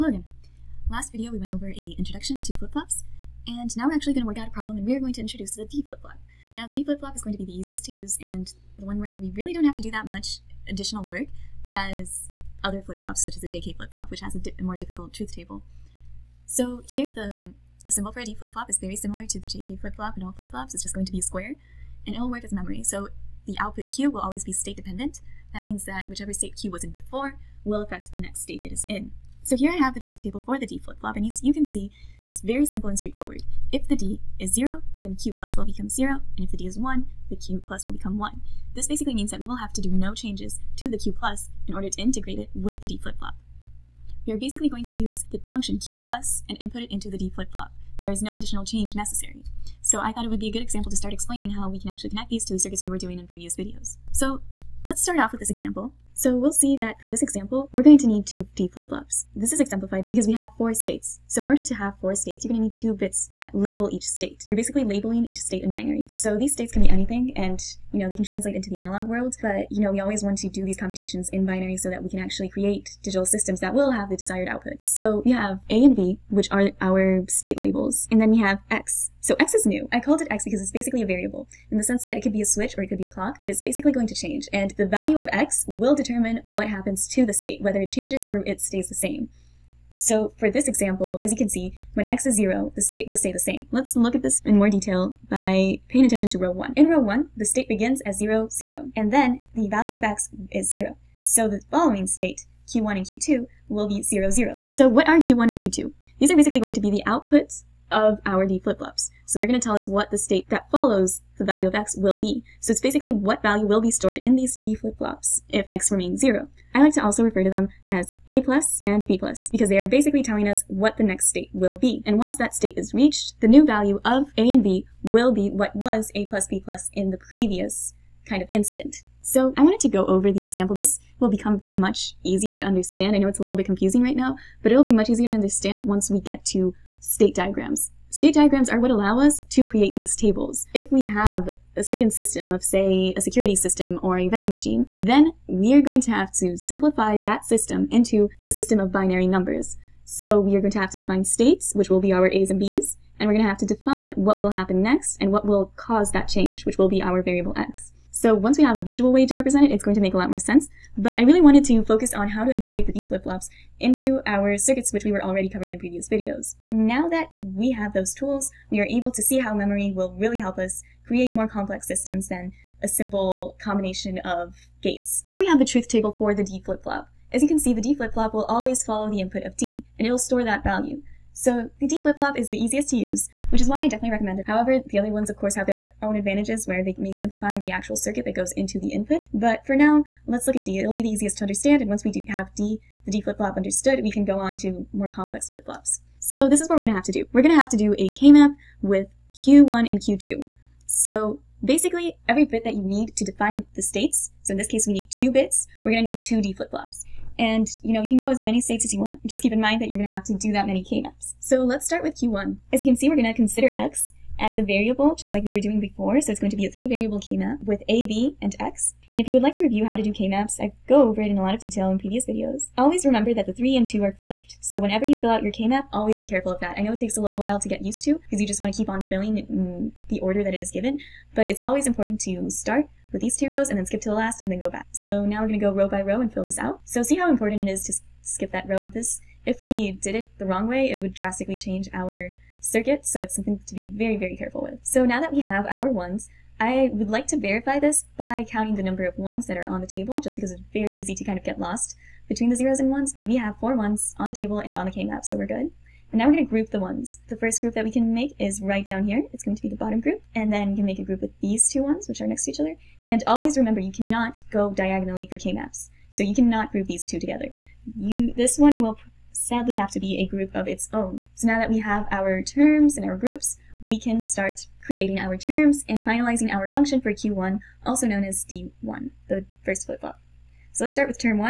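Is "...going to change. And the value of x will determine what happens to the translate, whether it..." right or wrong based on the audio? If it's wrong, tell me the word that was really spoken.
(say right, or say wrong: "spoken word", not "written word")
wrong: "state", not "translate".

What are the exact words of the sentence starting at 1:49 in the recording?
So they're going to tell us what the state that follows the value of x will be.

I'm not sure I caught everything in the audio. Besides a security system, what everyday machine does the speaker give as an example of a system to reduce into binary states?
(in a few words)
vending machine.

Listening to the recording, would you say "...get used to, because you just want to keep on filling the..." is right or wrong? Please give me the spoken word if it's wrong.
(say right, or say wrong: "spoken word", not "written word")
right.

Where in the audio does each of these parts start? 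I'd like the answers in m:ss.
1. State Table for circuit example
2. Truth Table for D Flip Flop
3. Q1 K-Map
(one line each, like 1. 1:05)
1. 0:53
2. 0:29
3. 3:21.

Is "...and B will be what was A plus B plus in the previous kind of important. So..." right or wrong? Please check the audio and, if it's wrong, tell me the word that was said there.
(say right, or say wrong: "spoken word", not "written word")
wrong: "instant", not "important".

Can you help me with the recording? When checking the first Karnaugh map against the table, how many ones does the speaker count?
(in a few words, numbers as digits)
4.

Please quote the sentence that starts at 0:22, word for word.
So the output Q will always be state dependent.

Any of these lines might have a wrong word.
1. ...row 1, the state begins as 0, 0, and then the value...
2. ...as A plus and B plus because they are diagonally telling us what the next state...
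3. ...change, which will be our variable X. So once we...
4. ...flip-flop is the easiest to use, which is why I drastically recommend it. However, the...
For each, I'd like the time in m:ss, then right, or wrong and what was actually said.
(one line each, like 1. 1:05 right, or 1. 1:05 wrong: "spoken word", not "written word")
1. 1:36 right
2. 1:57 wrong: "basically", not "diagonally"
3. 2:36 right
4. 3:01 wrong: "definitely", not "drastically".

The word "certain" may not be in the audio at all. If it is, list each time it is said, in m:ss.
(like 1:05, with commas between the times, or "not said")
2:21.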